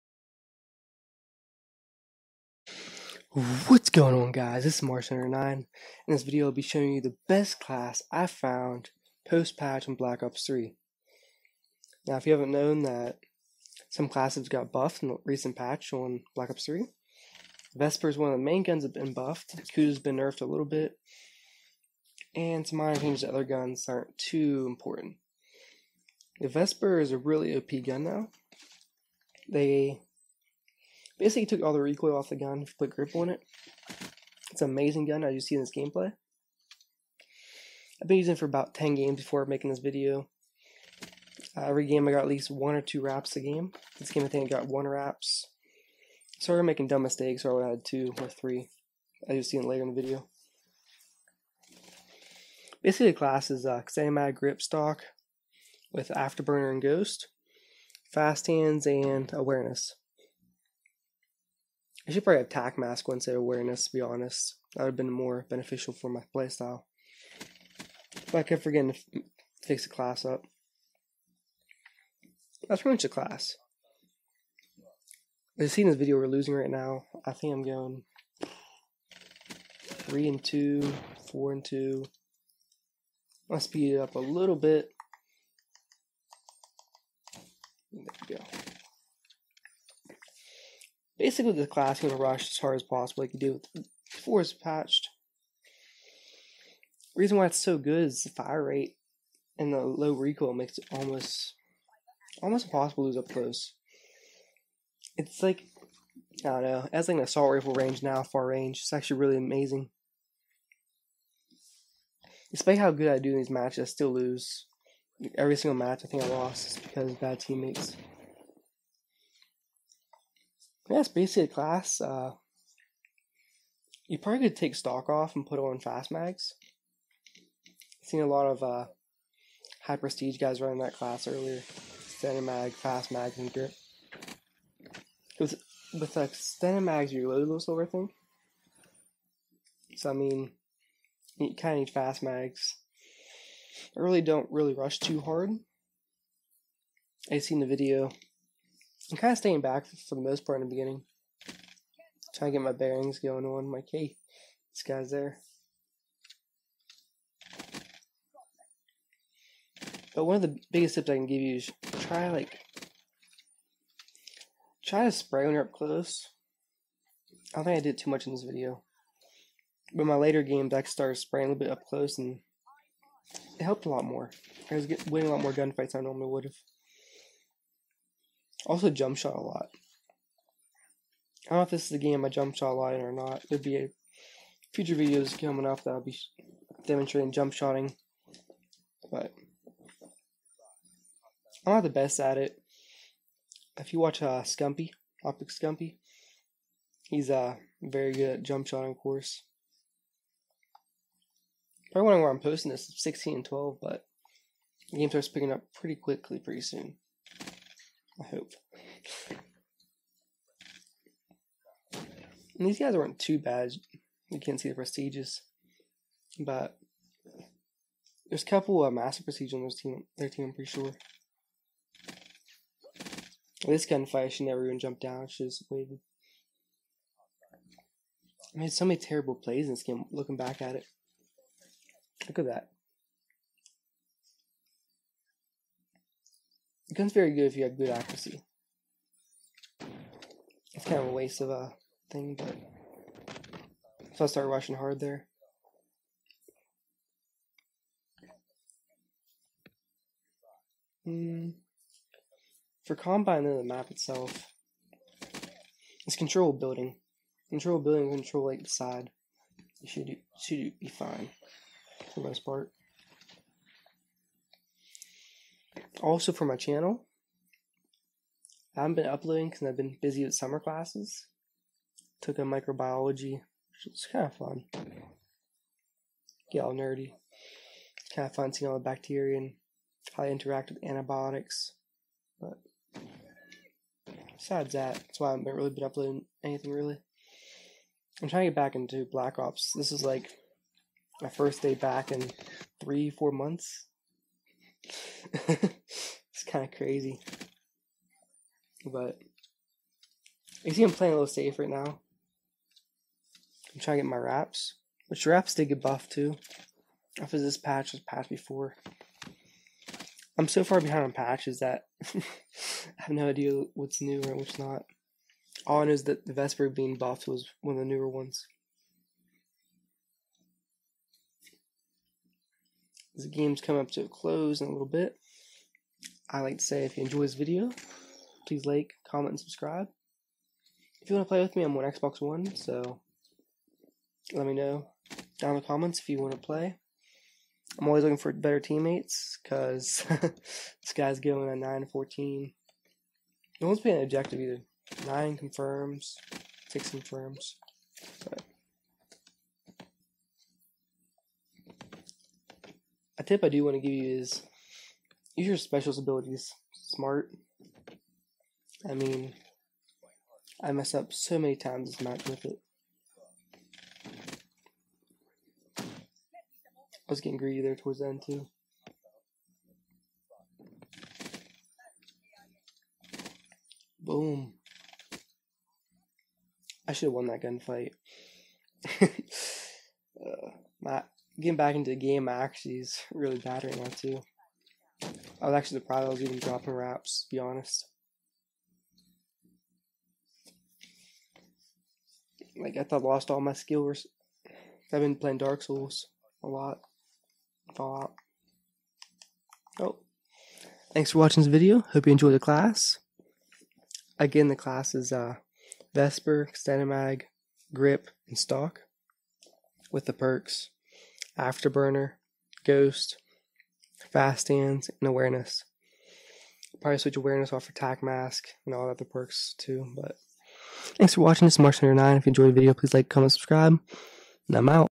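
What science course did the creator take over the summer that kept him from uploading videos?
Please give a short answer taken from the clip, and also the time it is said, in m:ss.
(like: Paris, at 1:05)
Microbiology, at 4:32.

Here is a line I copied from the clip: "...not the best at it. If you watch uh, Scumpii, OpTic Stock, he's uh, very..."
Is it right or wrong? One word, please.
wrong.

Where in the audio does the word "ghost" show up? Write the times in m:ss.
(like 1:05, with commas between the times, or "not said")
0:56, 6:52.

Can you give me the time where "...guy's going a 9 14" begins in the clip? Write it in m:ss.
5:40.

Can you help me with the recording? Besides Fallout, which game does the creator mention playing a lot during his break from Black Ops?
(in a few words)
Dark Souls.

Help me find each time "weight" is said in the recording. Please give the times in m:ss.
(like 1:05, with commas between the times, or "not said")
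not said.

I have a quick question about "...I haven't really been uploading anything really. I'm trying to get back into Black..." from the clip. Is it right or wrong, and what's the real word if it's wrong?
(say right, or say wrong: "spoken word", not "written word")
right.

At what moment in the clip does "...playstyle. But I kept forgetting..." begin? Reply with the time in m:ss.
1:06.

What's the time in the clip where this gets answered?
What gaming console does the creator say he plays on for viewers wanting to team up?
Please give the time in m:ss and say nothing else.
5:31.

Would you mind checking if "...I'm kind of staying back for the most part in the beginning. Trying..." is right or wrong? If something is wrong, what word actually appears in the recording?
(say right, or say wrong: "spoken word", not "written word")
right.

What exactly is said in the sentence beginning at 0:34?
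It's an amazing gun, as you see in this gameplay.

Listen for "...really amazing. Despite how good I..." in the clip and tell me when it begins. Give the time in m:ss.
1:49.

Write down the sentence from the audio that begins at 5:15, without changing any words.
All I know is that the Vesper being buffed was one of the newer ones.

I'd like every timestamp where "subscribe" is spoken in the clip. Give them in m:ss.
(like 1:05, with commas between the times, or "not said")
5:29, 7:03.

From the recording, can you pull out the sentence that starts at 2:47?
I don't think I did too much in this video.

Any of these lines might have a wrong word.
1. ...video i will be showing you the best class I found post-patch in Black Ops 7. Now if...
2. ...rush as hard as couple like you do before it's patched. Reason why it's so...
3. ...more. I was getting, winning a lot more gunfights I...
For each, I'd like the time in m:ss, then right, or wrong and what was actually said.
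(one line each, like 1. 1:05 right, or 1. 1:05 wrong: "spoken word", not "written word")
1. 0:06 wrong: "3", not "7"
2. 1:32 wrong: "possible", not "couple"
3. 2:54 right.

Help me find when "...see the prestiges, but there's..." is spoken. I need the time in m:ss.
3:34.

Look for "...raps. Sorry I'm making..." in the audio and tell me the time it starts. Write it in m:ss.
0:44.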